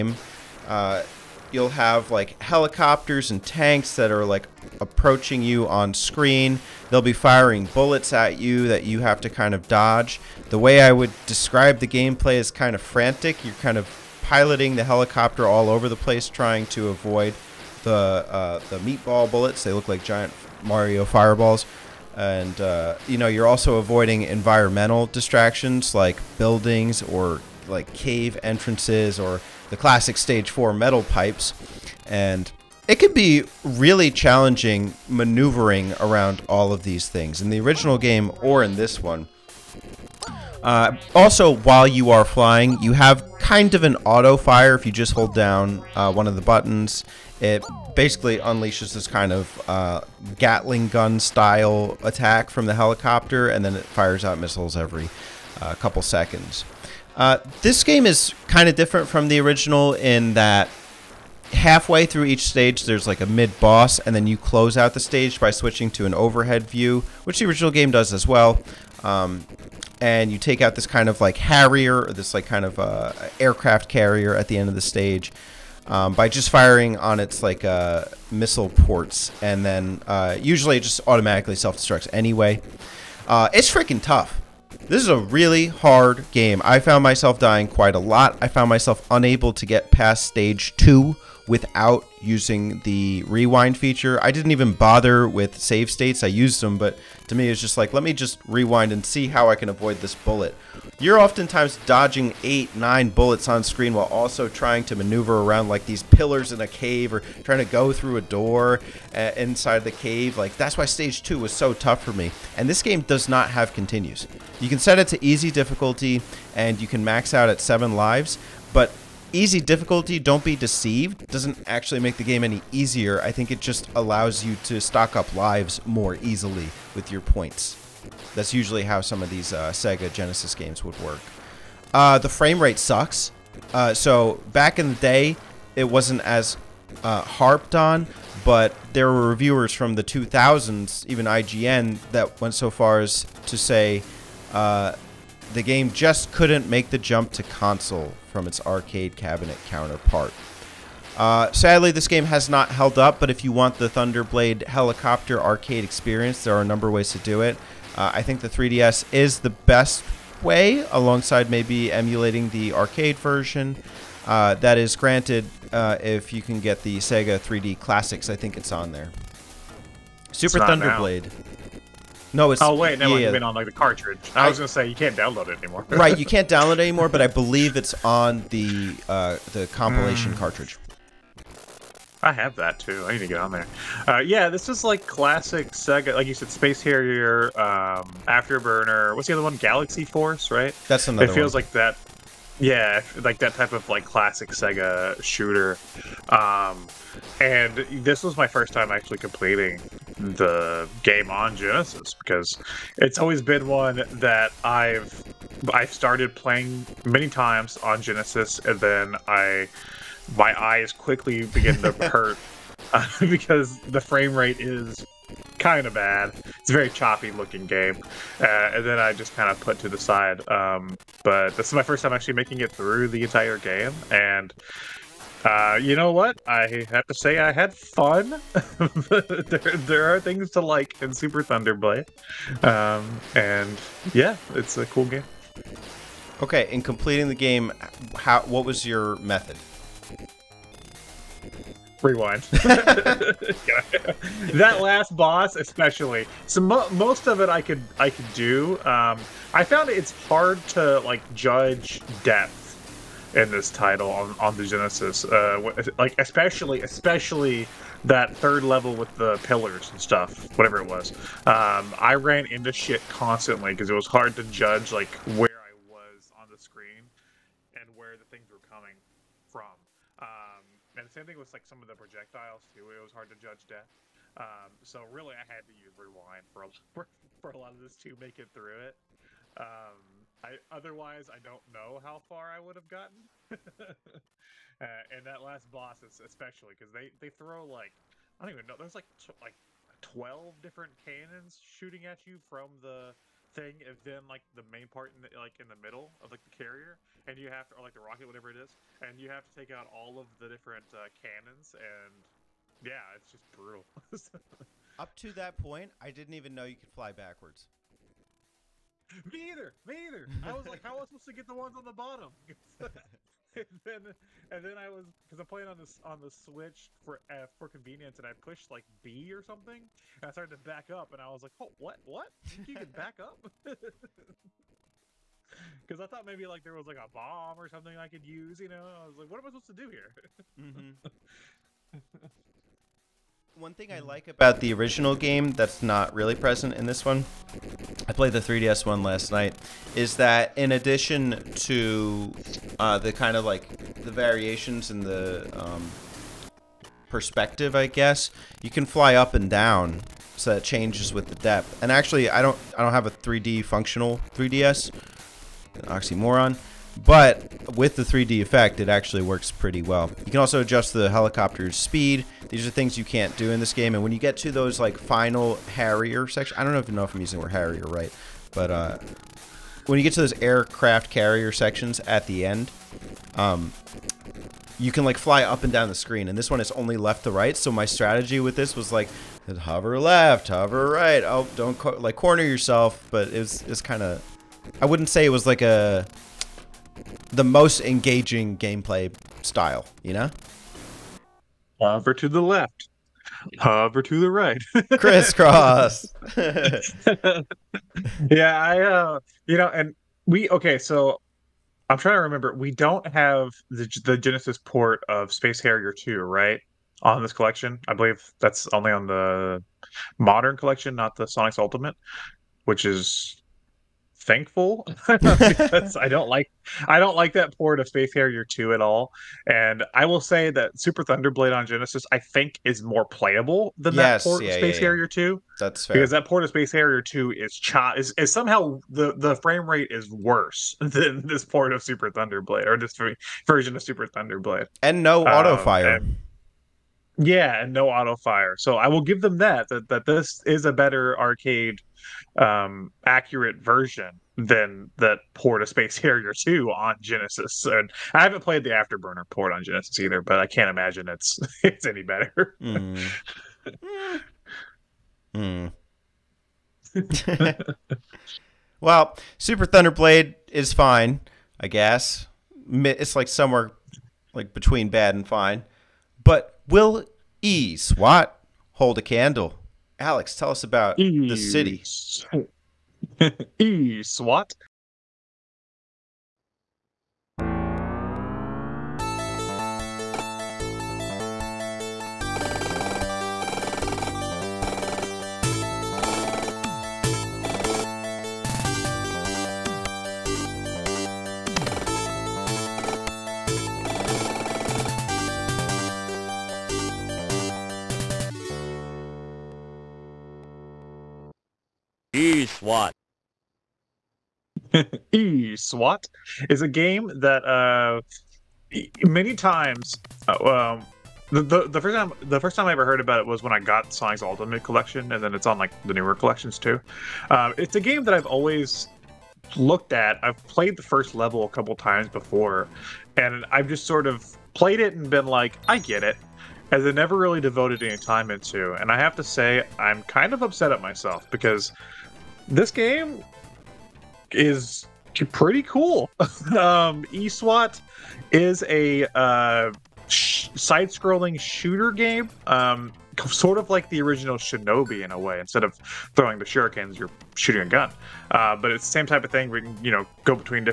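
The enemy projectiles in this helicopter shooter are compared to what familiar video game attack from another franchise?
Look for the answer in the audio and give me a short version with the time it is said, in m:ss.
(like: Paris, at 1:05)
Mario fireballs, at 0:20.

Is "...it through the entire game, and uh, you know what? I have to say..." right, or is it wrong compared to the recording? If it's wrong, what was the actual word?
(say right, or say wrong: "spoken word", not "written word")
right.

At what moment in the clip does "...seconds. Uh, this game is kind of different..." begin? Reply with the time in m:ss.
0:55.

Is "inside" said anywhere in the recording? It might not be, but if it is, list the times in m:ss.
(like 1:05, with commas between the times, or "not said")
1:49.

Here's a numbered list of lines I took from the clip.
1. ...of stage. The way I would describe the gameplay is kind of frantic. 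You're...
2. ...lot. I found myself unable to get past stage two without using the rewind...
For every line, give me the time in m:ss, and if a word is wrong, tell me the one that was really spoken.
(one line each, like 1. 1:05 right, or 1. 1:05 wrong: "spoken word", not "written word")
1. 0:09 wrong: "dodge", not "stage"
2. 1:27 right.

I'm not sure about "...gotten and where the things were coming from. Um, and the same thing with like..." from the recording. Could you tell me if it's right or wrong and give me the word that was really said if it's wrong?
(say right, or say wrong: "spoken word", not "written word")
wrong: "screen", not "gotten".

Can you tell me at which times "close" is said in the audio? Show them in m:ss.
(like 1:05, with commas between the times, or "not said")
1:04.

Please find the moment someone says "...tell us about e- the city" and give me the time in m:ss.
7:50.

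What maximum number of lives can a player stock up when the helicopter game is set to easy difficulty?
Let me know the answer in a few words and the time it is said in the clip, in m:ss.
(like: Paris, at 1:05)
7, at 1:57.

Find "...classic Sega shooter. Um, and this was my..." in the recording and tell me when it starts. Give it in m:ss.
3:14.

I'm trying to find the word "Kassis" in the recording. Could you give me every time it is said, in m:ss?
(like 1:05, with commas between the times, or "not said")
not said.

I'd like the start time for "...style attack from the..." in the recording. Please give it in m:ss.
0:51.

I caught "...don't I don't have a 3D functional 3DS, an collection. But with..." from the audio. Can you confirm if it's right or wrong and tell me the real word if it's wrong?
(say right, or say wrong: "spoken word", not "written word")
wrong: "oxymoron", not "collection".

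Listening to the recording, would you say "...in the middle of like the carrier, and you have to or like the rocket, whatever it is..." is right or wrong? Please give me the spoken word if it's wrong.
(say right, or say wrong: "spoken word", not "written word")
right.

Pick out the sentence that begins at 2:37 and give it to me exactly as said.
Uh, I think the 3DS is the best way, alongside maybe emulating the arcade version.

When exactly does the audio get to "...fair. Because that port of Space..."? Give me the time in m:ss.
7:05.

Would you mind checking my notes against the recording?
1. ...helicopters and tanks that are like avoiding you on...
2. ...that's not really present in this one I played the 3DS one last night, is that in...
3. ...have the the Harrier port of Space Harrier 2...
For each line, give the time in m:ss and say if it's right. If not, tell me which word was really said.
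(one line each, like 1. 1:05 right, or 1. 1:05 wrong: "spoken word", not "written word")
1. 0:02 wrong: "approaching", not "avoiding"
2. 5:35 right
3. 6:43 wrong: "Genesis", not "Harrier".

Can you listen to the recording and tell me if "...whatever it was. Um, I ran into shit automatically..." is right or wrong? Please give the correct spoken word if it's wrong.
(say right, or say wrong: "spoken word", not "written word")
wrong: "constantly", not "automatically".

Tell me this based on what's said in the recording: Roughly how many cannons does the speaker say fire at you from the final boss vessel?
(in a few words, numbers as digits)
12.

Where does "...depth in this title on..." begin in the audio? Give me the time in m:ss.
4:12.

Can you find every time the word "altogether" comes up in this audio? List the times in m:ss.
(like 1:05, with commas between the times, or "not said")
not said.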